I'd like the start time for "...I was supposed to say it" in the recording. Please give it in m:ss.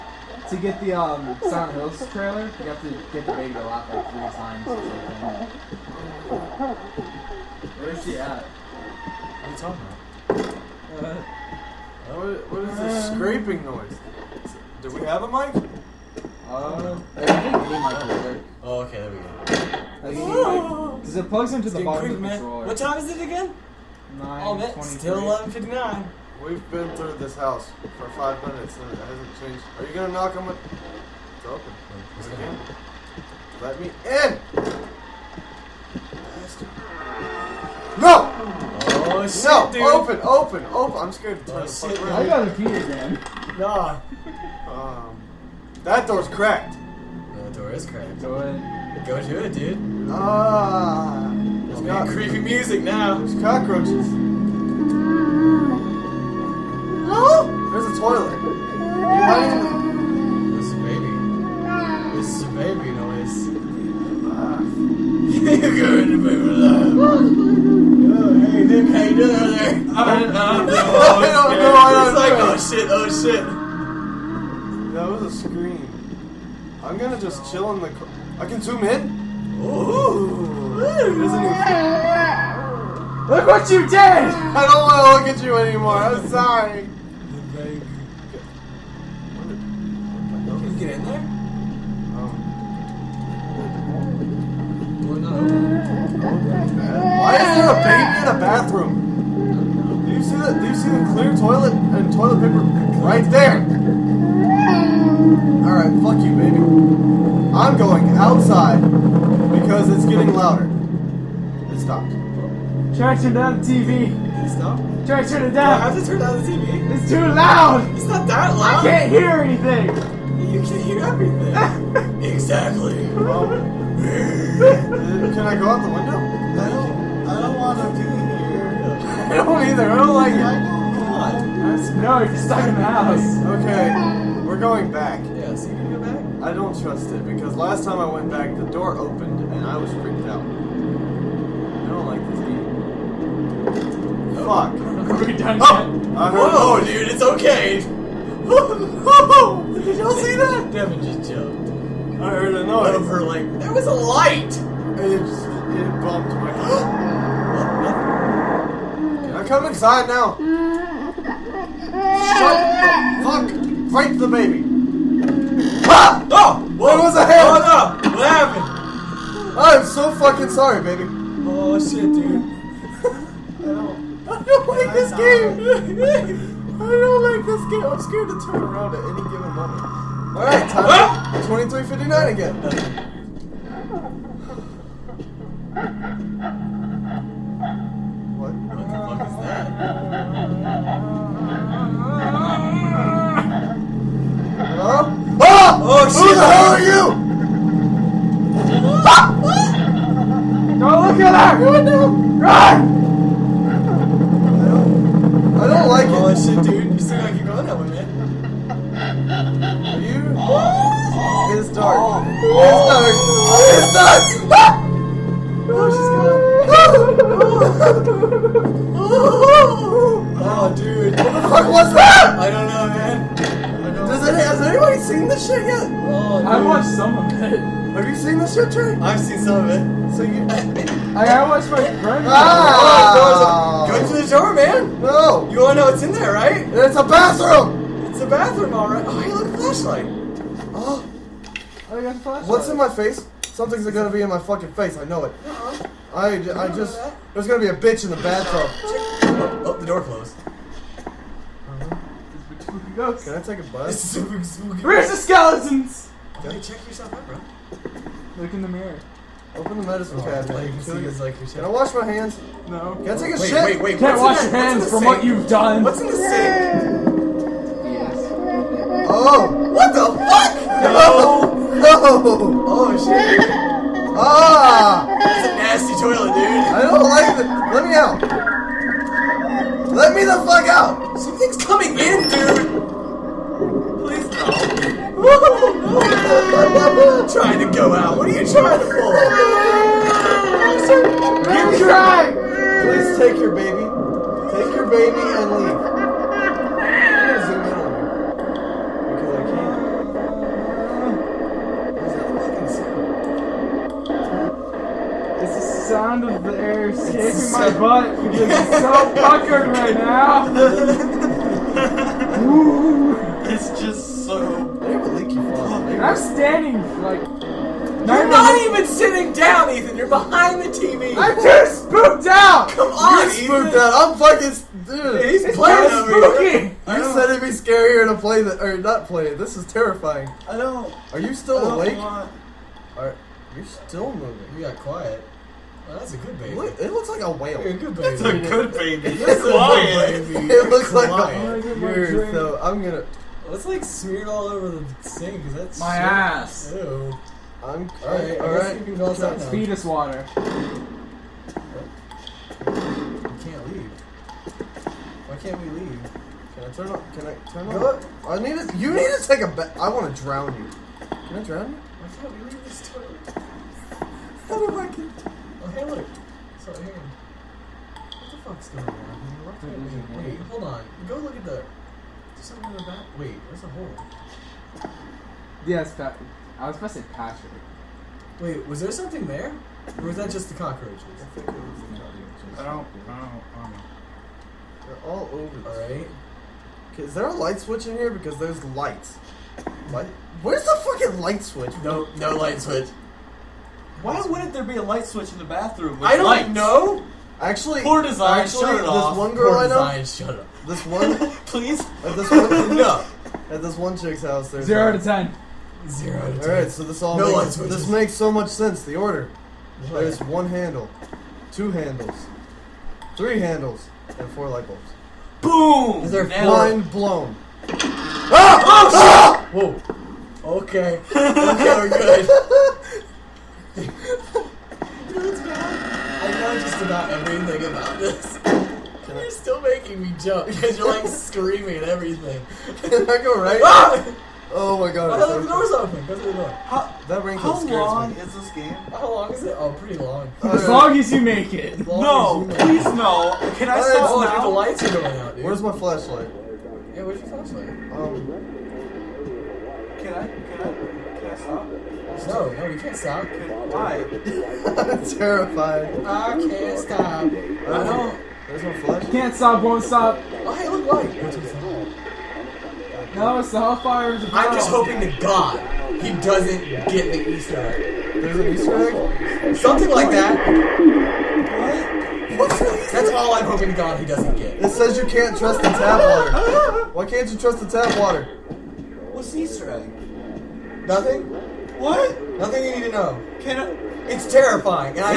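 6:16.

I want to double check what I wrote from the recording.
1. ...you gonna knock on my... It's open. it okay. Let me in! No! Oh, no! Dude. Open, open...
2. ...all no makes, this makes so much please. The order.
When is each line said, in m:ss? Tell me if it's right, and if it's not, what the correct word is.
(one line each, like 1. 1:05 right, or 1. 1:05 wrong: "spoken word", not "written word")
1. 0:29 right
2. 6:47 wrong: "sense", not "please".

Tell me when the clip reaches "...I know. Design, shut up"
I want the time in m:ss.
6:39.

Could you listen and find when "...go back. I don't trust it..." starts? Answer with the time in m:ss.
2:15.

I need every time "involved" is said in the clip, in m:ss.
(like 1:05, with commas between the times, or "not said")
not said.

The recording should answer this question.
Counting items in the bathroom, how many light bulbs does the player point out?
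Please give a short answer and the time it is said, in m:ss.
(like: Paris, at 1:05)
4, at 6:54.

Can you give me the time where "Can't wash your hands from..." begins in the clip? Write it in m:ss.
4:23.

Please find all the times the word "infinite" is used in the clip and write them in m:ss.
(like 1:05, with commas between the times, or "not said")
not said.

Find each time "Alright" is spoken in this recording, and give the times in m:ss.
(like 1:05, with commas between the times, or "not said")
1:45, 6:25.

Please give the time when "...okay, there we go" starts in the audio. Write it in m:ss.
0:18.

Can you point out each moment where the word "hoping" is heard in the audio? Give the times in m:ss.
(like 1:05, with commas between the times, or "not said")
7:44, 7:53.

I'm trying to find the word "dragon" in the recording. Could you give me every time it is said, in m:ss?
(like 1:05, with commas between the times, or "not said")
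not said.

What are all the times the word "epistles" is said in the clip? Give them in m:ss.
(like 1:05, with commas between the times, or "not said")
not said.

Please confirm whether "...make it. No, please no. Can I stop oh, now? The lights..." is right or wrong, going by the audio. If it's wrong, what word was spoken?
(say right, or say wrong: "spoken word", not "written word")
right.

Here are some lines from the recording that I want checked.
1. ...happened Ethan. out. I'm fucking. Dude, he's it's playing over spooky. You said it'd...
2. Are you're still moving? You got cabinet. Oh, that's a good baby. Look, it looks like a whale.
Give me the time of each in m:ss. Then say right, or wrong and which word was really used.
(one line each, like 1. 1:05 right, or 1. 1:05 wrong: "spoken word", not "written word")
1. 5:23 wrong: "spooked", not "happened"
2. 5:32 wrong: "quiet", not "cabinet".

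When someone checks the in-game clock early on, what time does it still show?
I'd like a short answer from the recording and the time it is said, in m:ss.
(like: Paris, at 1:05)
11:59, at 0:25.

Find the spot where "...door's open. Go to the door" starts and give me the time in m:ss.
7:15.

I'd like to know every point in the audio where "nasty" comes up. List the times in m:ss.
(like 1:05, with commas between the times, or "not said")
4:35.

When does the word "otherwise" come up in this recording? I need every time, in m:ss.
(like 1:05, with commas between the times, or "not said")
not said.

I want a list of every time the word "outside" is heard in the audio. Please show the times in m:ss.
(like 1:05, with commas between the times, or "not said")
1:48, 5:49.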